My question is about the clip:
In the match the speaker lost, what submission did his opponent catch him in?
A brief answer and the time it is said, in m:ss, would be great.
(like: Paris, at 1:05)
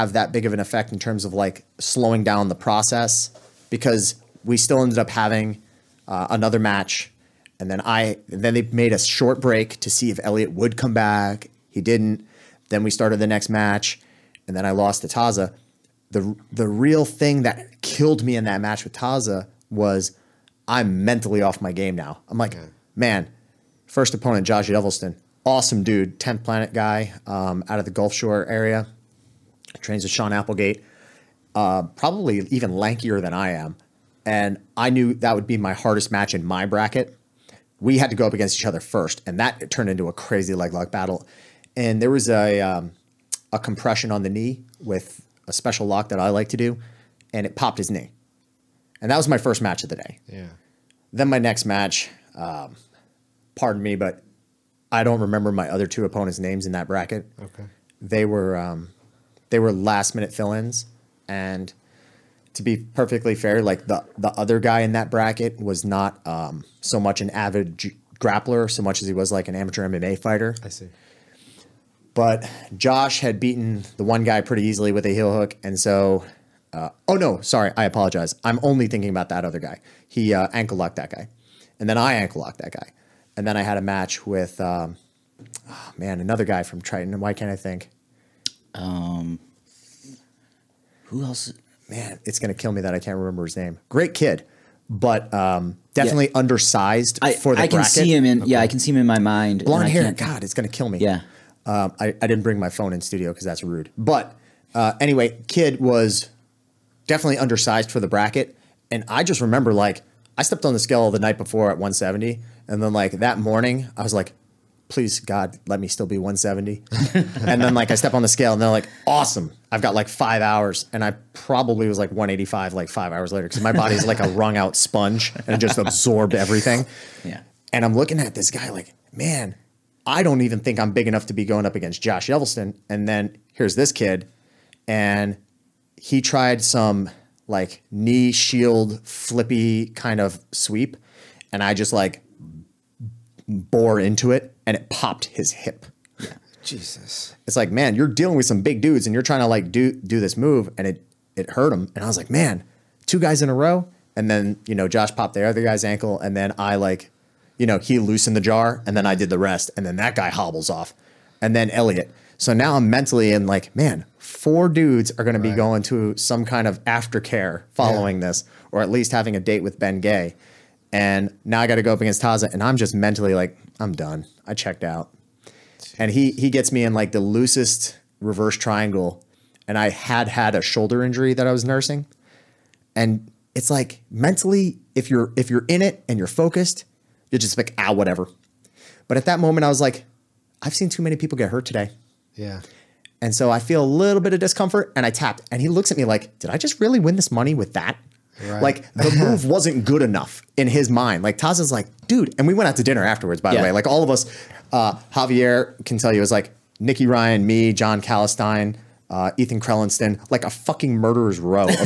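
reverse triangle, at 2:58.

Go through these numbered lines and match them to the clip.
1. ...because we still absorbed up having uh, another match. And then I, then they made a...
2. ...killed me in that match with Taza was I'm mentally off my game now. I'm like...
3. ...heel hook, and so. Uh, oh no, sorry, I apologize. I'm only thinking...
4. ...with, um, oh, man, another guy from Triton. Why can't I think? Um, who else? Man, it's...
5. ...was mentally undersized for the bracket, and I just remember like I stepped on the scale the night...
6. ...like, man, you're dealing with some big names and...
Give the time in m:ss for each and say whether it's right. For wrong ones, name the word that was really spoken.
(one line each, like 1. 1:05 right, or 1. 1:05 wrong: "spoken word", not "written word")
1. 0:03 wrong: "ended", not "absorbed"
2. 0:17 right
3. 1:15 right
4. 1:24 right
5. 1:45 wrong: "definitely", not "mentally"
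6. 2:27 wrong: "dudes", not "names".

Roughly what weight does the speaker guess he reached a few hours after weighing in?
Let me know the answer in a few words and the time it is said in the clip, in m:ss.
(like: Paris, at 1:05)
185, at 2:02.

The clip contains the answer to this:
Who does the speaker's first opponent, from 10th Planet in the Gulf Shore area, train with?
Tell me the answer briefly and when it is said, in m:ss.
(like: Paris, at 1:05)
Sean Applegate, at 0:30.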